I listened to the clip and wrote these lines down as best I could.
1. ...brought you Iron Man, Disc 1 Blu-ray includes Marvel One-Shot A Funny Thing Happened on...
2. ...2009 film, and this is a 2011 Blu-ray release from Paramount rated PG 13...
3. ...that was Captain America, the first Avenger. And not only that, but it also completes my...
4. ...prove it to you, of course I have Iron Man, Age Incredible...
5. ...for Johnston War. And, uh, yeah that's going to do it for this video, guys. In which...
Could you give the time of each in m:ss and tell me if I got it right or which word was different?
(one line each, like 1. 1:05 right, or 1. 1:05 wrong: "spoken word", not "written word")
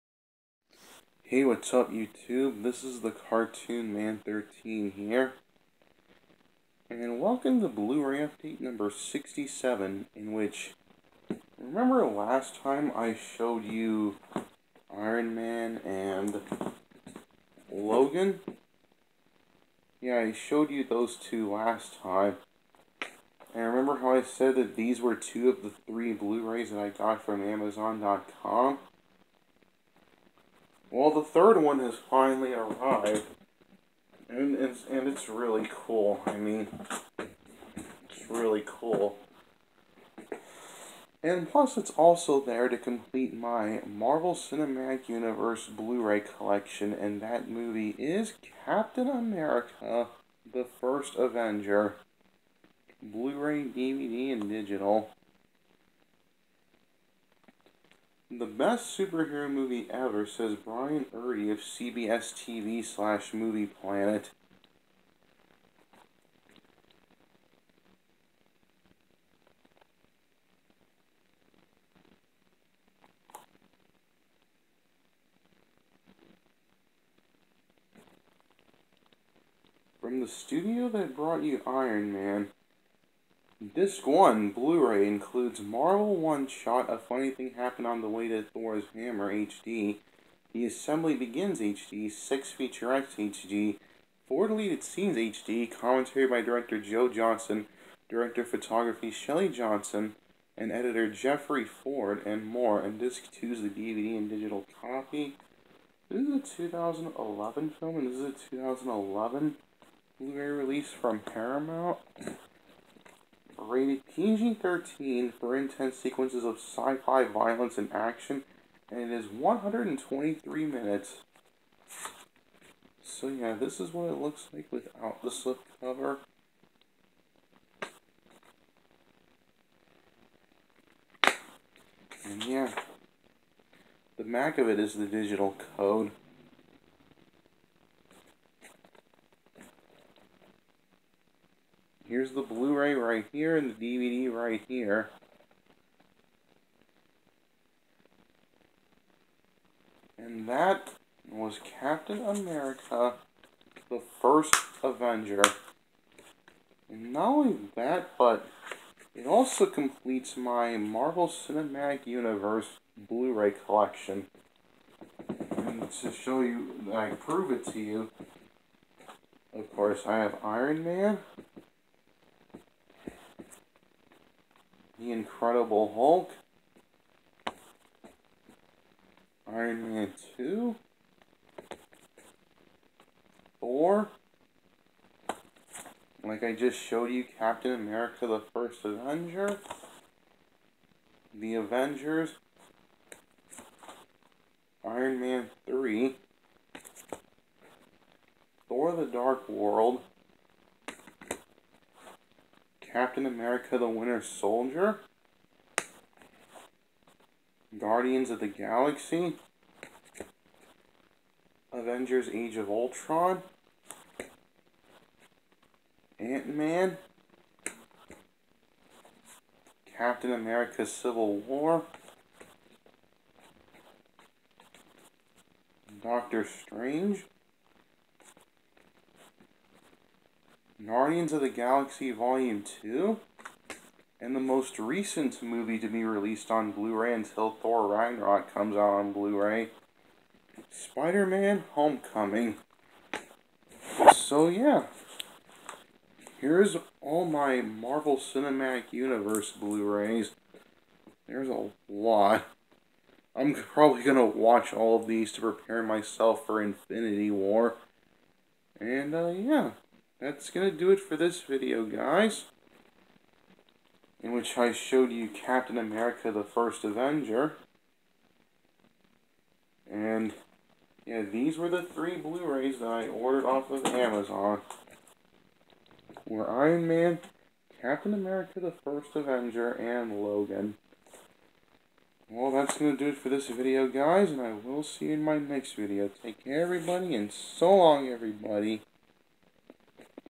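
1. 1:21 right
2. 1:46 wrong: "2011", not "2009"
3. 2:30 right
4. 2:47 wrong: "The", not "Age"
5. 4:16 wrong: "Infinity", not "Johnston".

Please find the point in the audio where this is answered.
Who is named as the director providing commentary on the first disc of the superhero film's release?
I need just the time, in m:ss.
1:36.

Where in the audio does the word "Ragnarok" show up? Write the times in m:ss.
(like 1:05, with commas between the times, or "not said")
3:57.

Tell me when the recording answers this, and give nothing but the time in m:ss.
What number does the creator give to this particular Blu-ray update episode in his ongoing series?
0:08.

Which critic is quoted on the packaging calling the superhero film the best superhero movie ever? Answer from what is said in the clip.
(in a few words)
Brian Erdy.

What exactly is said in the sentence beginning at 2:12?
And yeah, the back of it is the digital code.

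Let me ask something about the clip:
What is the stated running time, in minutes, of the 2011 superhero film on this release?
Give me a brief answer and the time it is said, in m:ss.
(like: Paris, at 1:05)
123, at 1:59.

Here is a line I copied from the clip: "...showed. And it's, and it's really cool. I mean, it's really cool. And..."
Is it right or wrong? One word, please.
wrong.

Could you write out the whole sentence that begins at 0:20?
Yeah, I showed you those two last time.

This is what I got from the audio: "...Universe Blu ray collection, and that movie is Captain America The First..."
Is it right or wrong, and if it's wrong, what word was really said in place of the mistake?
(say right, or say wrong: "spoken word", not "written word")
right.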